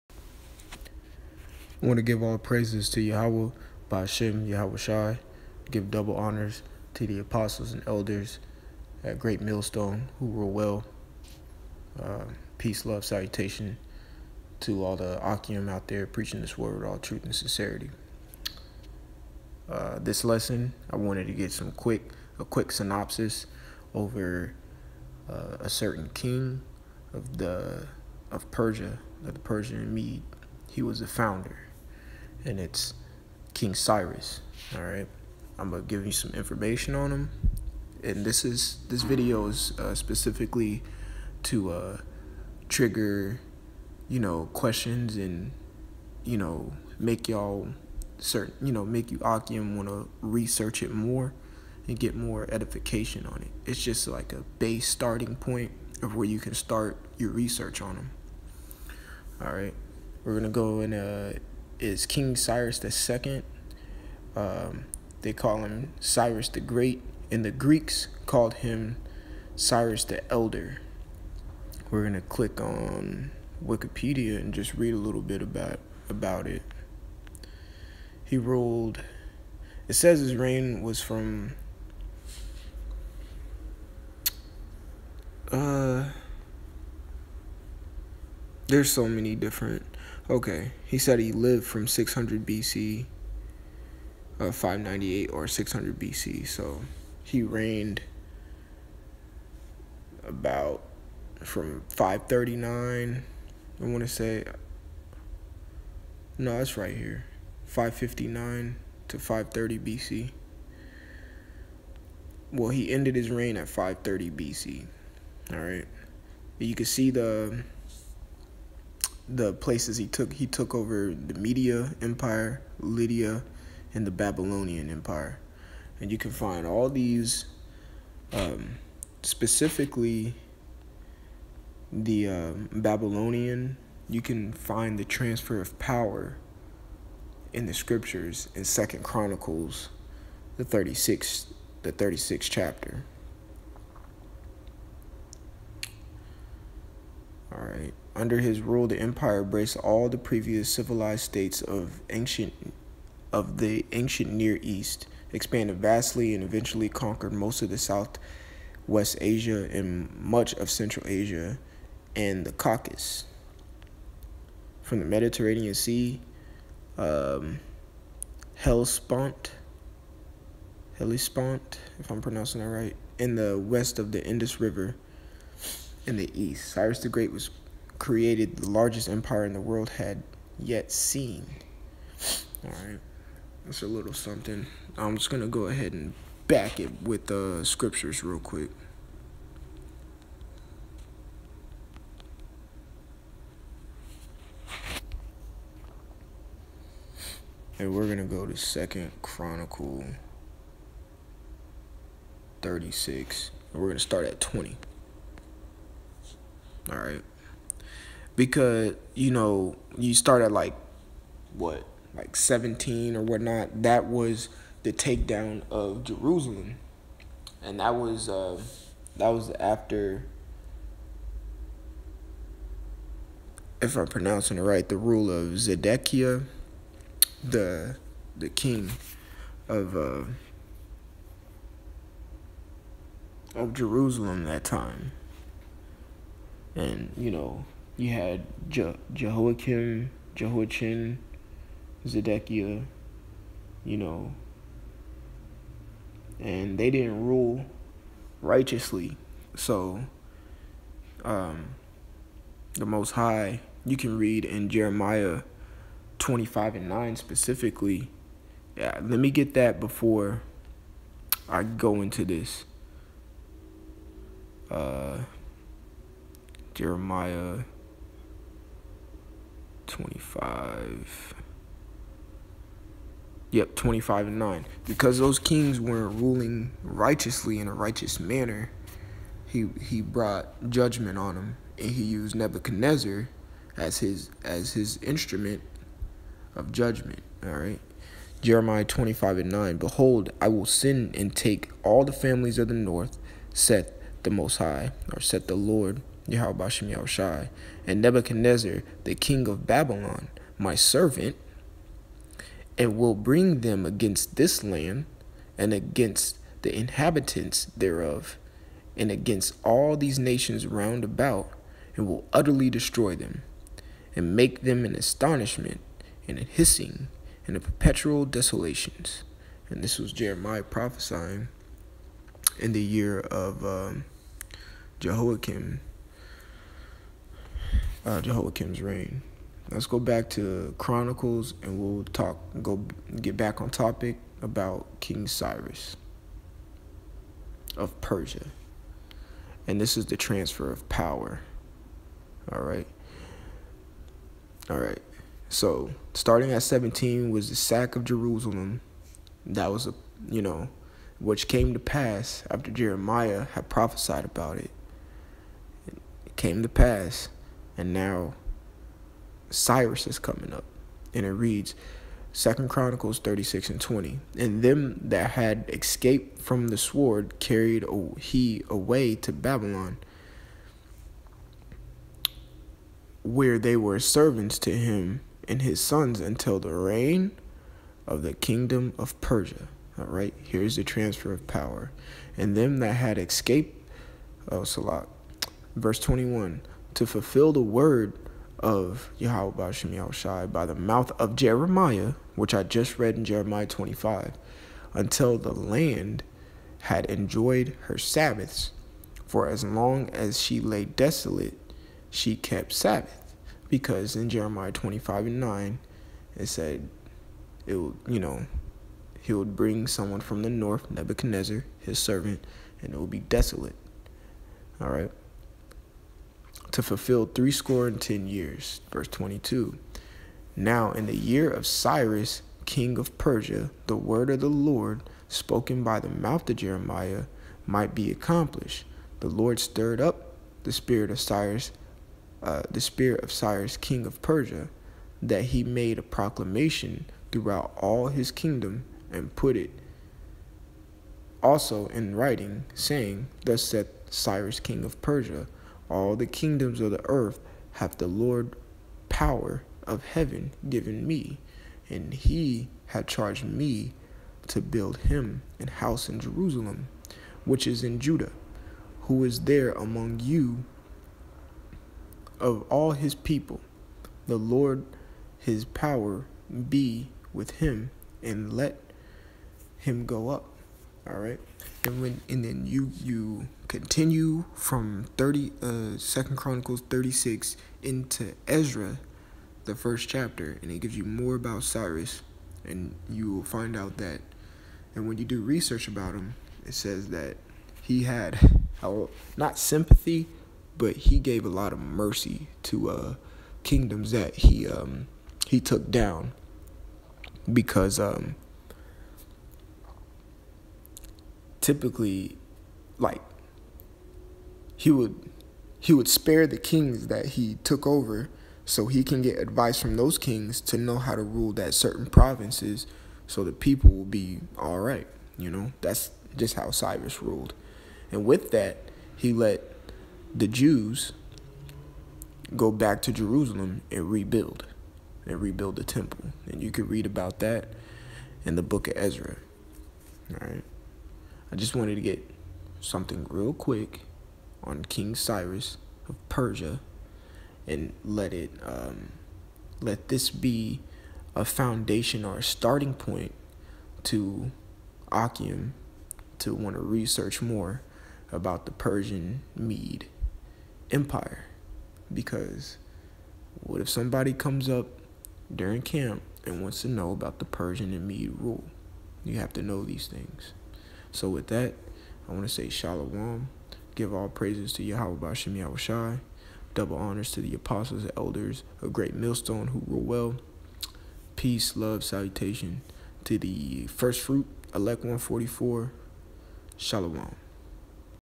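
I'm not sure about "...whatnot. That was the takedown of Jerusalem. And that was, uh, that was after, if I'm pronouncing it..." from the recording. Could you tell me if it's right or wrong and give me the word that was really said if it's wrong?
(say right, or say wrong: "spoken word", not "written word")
right.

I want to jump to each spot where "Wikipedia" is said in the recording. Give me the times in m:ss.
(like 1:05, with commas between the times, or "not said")
1:13.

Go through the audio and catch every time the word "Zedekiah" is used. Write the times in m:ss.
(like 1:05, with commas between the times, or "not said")
3:45, 4:02.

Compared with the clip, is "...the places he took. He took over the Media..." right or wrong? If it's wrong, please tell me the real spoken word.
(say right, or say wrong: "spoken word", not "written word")
right.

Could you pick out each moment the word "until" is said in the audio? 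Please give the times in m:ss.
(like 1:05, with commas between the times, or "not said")
6:16, 6:34.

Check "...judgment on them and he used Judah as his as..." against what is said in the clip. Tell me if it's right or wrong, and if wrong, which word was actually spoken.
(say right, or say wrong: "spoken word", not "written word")
wrong: "Nebuchadnezzar", not "Judah".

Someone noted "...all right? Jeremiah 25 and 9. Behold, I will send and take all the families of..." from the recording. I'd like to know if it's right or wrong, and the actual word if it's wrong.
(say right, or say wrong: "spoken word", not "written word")
right.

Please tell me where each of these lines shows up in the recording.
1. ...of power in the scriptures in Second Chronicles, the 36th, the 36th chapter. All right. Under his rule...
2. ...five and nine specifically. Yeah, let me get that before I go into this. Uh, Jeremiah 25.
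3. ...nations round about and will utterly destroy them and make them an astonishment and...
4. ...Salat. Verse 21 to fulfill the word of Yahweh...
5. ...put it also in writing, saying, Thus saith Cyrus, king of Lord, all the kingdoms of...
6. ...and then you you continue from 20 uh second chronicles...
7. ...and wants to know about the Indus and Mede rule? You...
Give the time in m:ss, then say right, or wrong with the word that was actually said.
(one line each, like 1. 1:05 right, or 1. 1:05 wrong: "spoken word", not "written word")
1. 2:15 right
2. 4:16 right
3. 5:10 right
4. 6:24 right
5. 7:19 wrong: "Persia", not "Lord"
6. 7:52 wrong: "30", not "20"
7. 9:16 wrong: "Persian", not "Indus".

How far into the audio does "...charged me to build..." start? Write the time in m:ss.
7:33.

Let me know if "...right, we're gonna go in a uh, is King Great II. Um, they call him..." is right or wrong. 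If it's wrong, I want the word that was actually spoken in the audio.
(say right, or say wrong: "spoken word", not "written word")
wrong: "Cyrus", not "Great".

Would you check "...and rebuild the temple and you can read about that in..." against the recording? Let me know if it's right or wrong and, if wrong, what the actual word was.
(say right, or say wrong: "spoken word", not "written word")
right.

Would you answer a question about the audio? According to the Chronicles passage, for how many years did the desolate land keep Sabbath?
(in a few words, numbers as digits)
70.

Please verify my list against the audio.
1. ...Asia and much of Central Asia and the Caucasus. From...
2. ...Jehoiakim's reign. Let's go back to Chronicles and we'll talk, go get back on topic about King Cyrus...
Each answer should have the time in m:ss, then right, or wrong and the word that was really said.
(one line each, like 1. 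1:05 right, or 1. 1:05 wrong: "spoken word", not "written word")
1. 2:39 right
2. 5:28 right.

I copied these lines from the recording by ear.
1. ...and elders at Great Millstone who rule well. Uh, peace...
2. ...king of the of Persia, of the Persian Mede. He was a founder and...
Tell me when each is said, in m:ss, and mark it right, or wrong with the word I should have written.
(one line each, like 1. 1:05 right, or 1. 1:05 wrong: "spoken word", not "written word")
1. 0:07 right
2. 0:26 right.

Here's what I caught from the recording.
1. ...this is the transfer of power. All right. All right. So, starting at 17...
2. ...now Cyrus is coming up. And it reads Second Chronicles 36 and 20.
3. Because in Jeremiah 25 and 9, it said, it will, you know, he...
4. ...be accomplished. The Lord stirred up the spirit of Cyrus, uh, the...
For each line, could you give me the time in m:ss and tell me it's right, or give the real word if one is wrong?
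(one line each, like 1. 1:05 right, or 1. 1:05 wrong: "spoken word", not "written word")
1. 5:39 right
2. 5:57 right
3. 6:43 right
4. 7:07 right.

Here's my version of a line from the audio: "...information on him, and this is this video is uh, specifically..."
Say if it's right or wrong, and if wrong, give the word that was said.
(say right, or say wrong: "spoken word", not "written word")
right.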